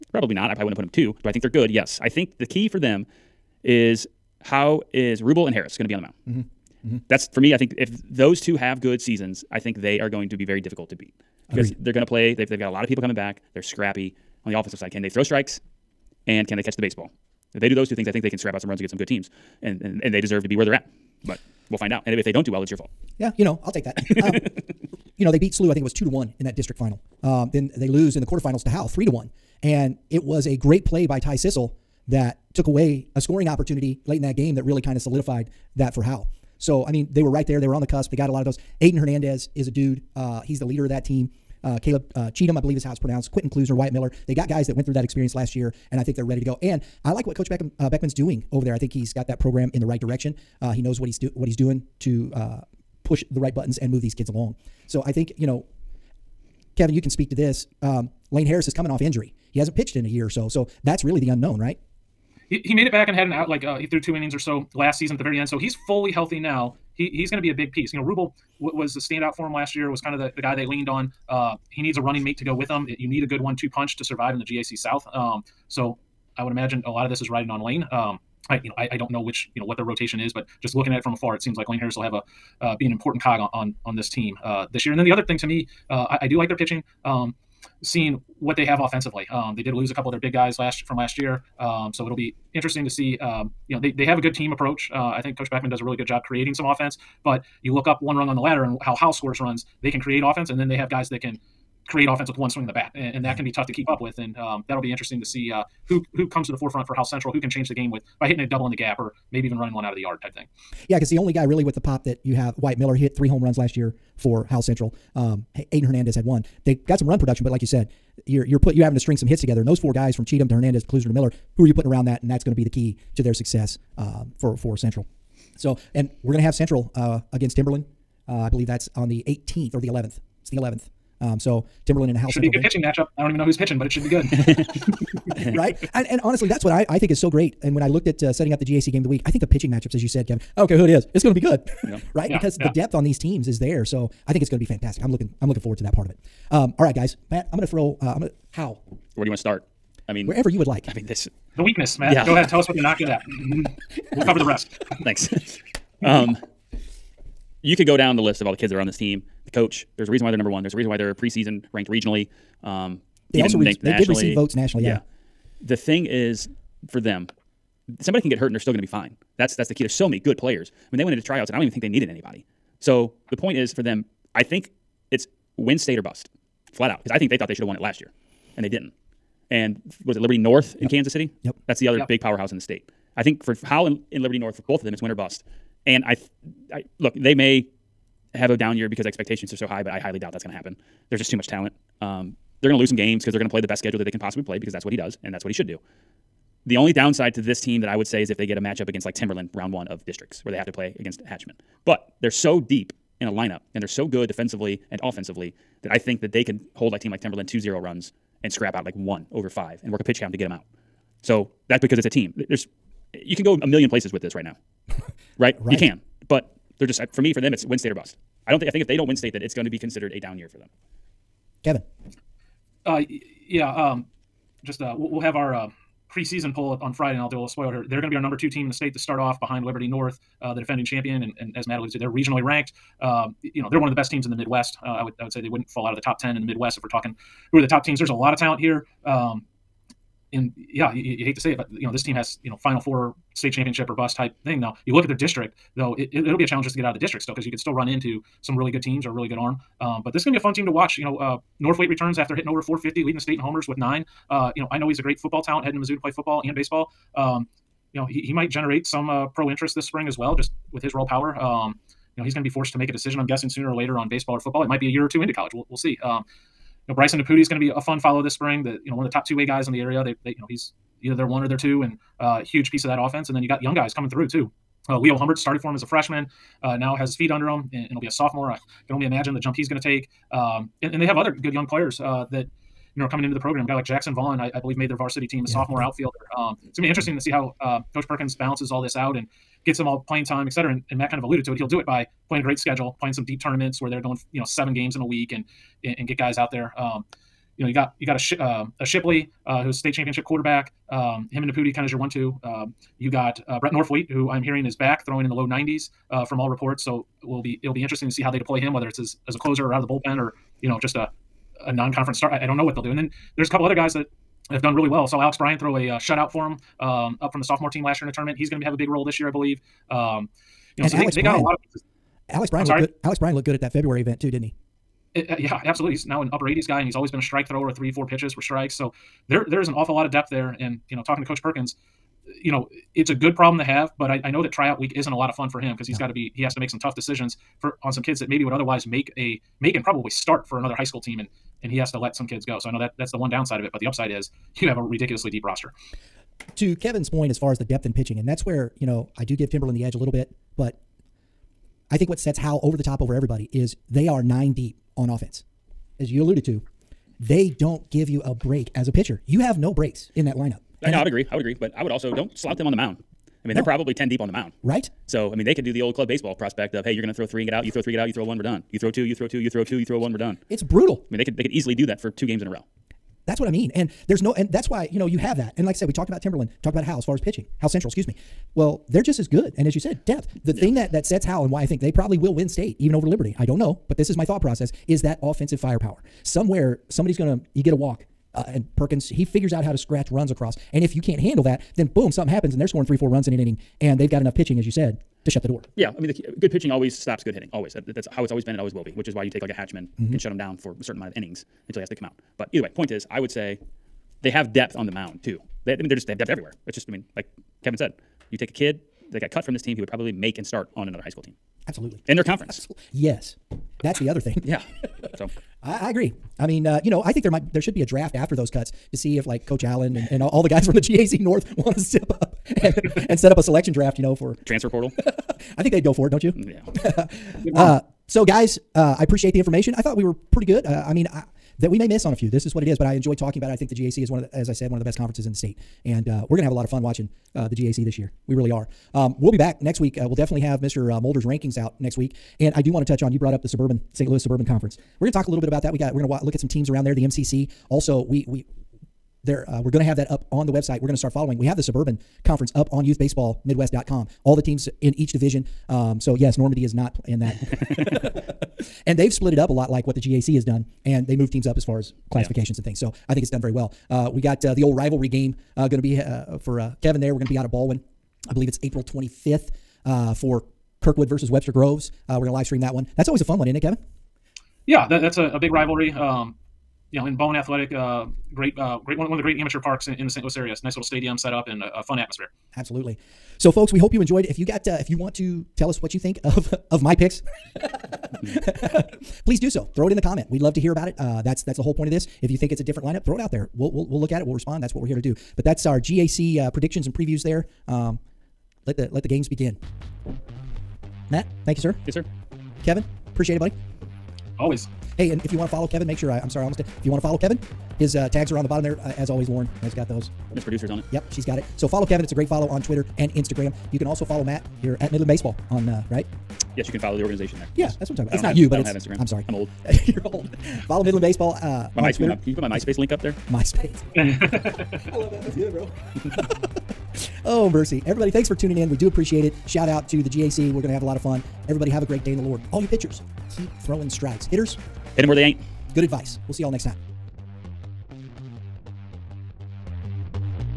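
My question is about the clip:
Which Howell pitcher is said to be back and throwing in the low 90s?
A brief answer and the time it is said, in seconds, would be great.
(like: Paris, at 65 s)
Brett Norfleet, at 303 s.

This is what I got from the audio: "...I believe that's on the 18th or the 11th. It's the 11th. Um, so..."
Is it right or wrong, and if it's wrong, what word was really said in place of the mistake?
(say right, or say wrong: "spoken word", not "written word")
right.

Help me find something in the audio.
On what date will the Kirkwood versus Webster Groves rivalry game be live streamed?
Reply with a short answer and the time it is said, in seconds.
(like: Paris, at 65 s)
April 25th, at 468 s.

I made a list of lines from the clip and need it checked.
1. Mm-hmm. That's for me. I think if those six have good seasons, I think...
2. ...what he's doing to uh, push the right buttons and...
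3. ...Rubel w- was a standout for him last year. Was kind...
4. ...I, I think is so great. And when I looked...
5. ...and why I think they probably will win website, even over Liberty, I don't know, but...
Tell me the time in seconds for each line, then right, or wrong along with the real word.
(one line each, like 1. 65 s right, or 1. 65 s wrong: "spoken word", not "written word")
1. 6 s wrong: "two", not "six"
2. 51 s right
3. 68 s right
4. 136 s right
5. 381 s wrong: "state", not "website".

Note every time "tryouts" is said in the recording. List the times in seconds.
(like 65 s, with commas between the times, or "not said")
171 s, 334 s.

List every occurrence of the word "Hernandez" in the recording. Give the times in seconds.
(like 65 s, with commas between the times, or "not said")
38 s, 115 s, 120 s.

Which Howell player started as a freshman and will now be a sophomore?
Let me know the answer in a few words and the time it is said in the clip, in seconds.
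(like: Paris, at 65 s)
Leo Humbert, at 274 s.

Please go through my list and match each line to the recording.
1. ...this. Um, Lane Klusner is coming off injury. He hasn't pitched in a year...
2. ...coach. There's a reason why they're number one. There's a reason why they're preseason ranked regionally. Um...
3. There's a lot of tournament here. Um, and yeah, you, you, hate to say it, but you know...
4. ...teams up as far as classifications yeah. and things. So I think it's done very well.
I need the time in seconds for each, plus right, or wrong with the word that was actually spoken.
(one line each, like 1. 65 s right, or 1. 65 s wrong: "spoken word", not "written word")
1. 57 s wrong: "Harris", not "Klusner"
2. 159 s right
3. 237 s wrong: "talent", not "tournament"
4. 461 s right.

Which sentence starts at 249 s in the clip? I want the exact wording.
Um, but this is going to be a fun team to watch.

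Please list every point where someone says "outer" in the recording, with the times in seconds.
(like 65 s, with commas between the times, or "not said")
not said.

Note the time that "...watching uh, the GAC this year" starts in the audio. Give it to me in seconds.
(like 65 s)
436 s.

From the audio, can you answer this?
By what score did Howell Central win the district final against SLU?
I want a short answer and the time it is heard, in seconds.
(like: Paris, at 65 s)
2 to 1, at 25 s.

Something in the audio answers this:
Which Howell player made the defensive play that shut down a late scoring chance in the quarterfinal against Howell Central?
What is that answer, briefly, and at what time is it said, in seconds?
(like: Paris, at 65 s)
Ty Sissel, at 31 s.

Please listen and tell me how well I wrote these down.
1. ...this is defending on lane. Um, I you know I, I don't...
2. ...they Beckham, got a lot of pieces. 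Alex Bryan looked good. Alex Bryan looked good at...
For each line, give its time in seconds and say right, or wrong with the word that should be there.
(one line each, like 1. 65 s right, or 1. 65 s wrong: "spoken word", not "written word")
1. 77 s wrong: "riding", not "defending"
2. 321 s wrong: "Bryan", not "Beckham".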